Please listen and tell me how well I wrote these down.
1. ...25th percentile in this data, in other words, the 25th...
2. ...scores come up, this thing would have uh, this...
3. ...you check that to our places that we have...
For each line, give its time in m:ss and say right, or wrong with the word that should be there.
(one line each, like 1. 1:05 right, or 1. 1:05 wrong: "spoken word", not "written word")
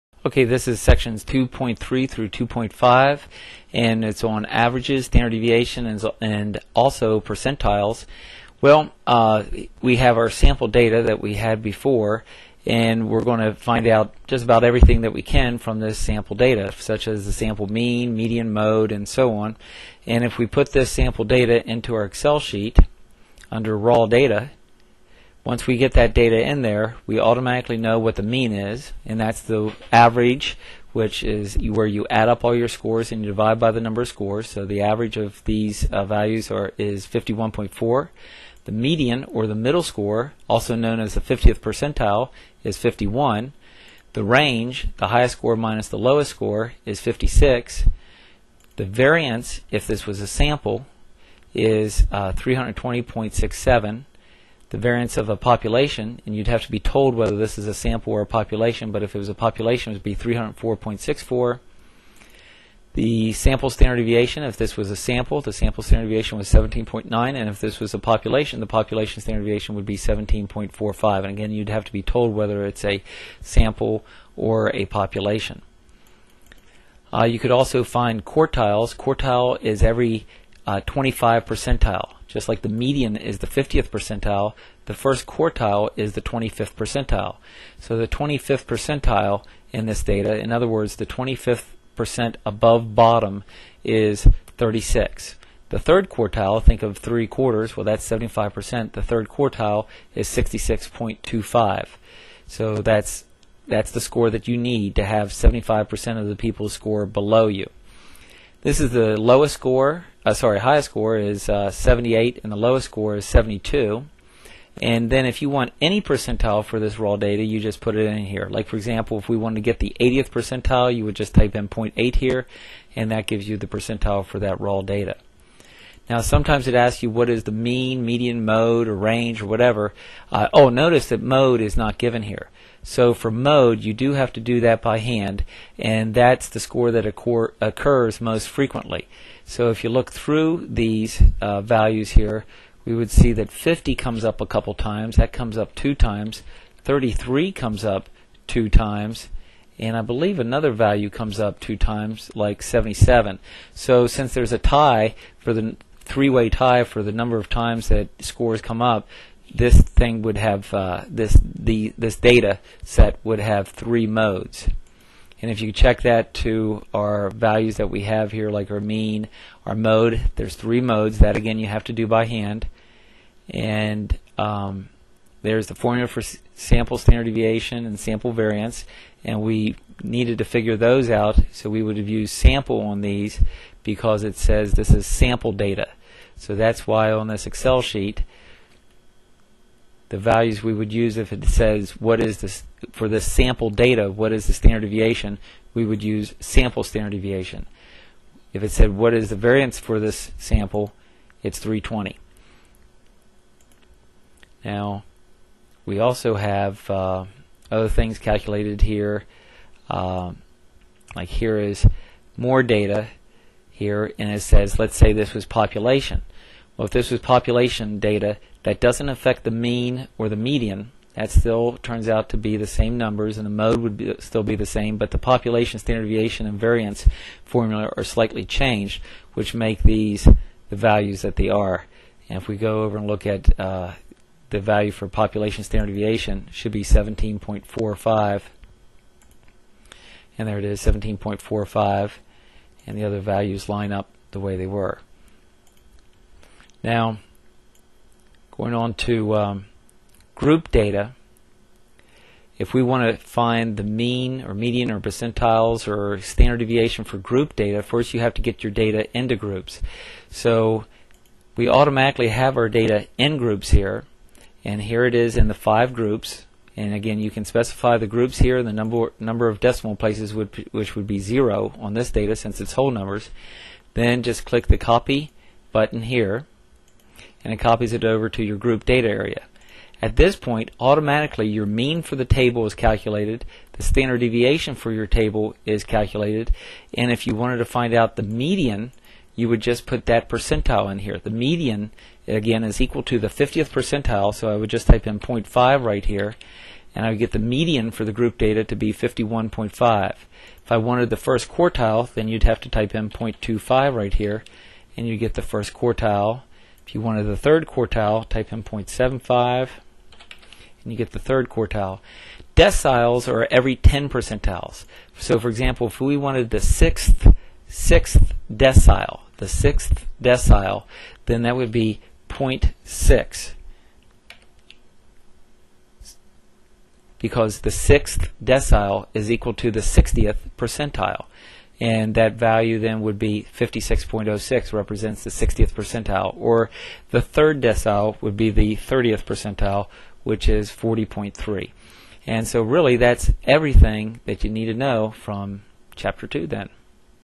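1. 1:28 right
2. 2:38 right
3. 2:45 wrong: "values", not "places".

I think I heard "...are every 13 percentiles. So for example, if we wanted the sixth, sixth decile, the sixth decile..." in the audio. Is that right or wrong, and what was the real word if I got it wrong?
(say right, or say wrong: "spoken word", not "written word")
wrong: "10", not "13".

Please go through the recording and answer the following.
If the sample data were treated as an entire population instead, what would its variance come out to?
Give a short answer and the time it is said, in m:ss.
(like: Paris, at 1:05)
304.64, at 1:00.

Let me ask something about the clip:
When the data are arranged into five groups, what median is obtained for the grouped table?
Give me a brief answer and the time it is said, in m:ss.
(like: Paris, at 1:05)
51.5, at 4:58.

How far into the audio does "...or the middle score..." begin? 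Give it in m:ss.
0:39.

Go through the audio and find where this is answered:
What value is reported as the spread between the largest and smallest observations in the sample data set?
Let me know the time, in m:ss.
0:46.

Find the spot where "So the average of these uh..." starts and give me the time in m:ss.
0:34.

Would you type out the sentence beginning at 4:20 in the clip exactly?
So we automatically have our data in groups here, and here it is in the five groups.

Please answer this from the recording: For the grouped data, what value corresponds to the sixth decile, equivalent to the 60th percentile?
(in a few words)
56.06.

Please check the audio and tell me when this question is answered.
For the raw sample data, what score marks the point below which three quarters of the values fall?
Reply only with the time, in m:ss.
1:40.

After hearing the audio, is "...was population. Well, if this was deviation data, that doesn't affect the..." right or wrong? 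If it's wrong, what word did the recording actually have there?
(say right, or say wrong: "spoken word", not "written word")
wrong: "population", not "deviation".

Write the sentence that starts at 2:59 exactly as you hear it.
And we needed to figure those out, so we would have used sample on these because it says this is sample data.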